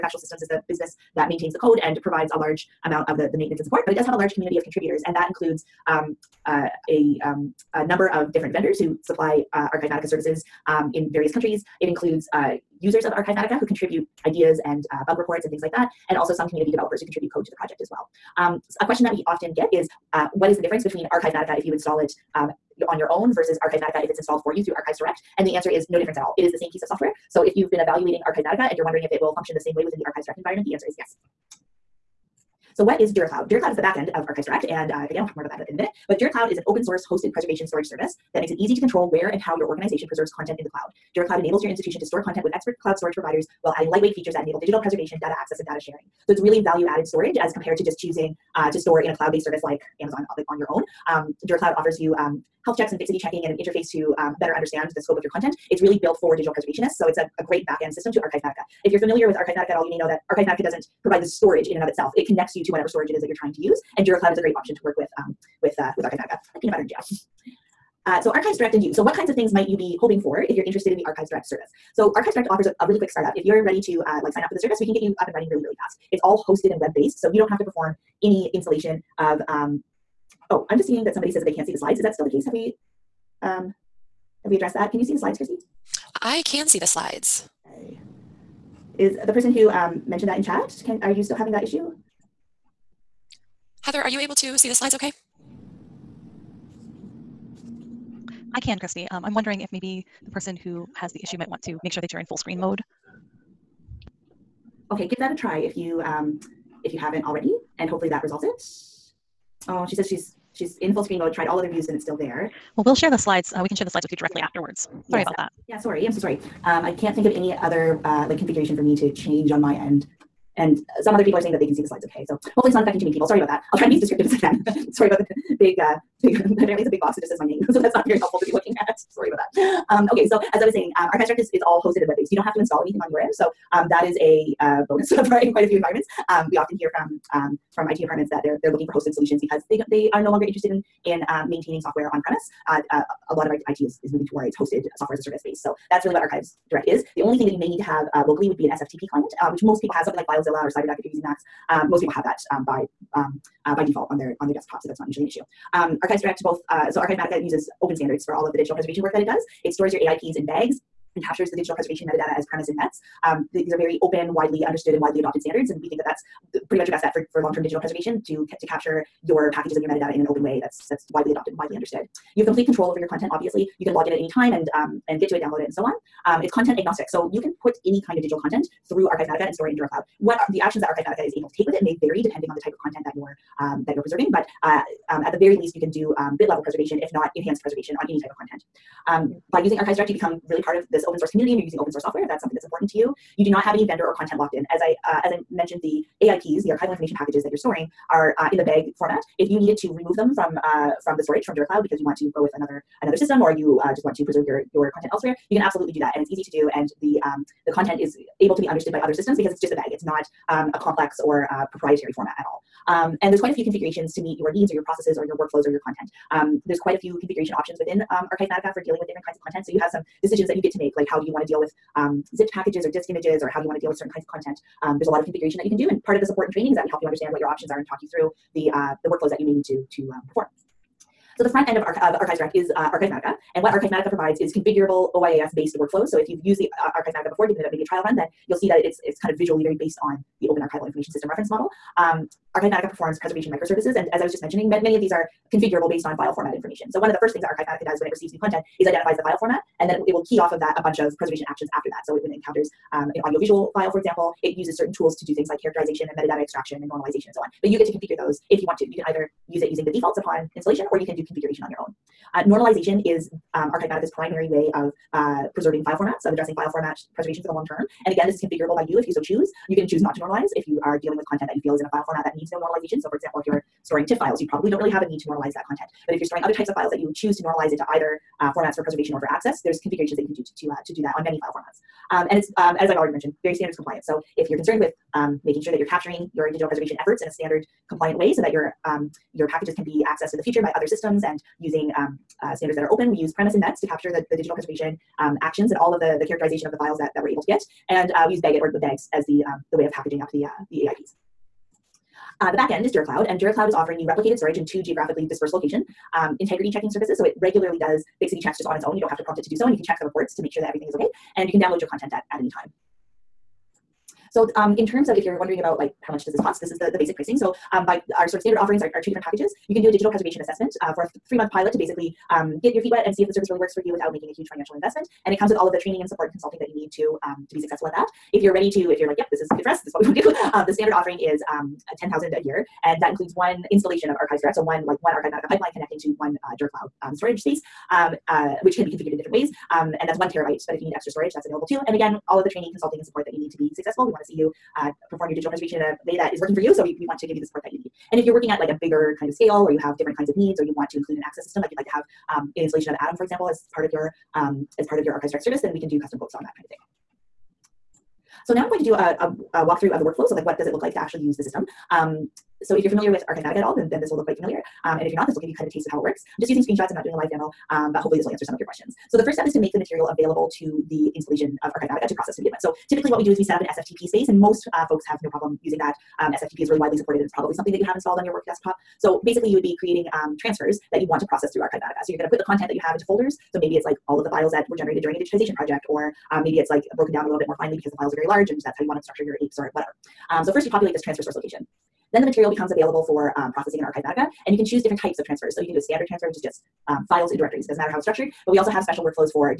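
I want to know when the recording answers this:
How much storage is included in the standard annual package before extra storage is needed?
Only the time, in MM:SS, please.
05:40.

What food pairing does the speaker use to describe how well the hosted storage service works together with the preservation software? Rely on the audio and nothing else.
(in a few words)
peanut butter and jam.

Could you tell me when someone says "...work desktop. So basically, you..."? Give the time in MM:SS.
06:18.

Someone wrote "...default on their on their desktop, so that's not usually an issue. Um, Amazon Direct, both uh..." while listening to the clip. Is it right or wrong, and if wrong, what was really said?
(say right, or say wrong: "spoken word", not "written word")
wrong: "Archives", not "Amazon".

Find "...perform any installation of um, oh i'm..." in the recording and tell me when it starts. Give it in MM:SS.
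01:17.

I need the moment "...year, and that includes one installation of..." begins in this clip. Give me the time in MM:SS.
05:32.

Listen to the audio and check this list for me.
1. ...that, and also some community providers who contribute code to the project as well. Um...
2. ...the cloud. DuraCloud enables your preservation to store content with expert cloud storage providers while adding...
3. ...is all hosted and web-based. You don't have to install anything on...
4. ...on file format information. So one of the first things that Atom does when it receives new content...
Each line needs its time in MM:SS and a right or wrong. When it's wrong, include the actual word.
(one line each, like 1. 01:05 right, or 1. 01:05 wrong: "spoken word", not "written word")
1. 00:15 wrong: "developers", not "providers"
2. 00:40 wrong: "institution", not "preservation"
3. 02:11 right
4. 04:06 wrong: "Archivematica", not "Atom".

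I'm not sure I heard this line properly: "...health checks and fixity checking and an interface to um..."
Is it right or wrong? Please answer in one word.
right.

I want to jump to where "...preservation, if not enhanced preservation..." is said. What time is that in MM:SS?
03:06.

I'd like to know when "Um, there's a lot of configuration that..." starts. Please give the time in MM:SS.
03:44.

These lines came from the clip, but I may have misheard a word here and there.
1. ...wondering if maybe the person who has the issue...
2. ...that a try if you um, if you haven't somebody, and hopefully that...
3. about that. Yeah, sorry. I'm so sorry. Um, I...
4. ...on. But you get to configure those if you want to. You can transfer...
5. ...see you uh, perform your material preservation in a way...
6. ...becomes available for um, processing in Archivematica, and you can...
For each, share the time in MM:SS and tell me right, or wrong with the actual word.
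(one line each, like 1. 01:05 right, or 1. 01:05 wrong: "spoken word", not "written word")
1. 01:39 right
2. 01:45 wrong: "already", not "somebody"
3. 01:55 right
4. 04:17 wrong: "either", not "transfer"
5. 05:44 wrong: "digital", not "material"
6. 06:32 right.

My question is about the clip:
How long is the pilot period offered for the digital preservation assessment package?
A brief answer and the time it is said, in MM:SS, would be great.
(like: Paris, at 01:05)
3 months, at 05:21.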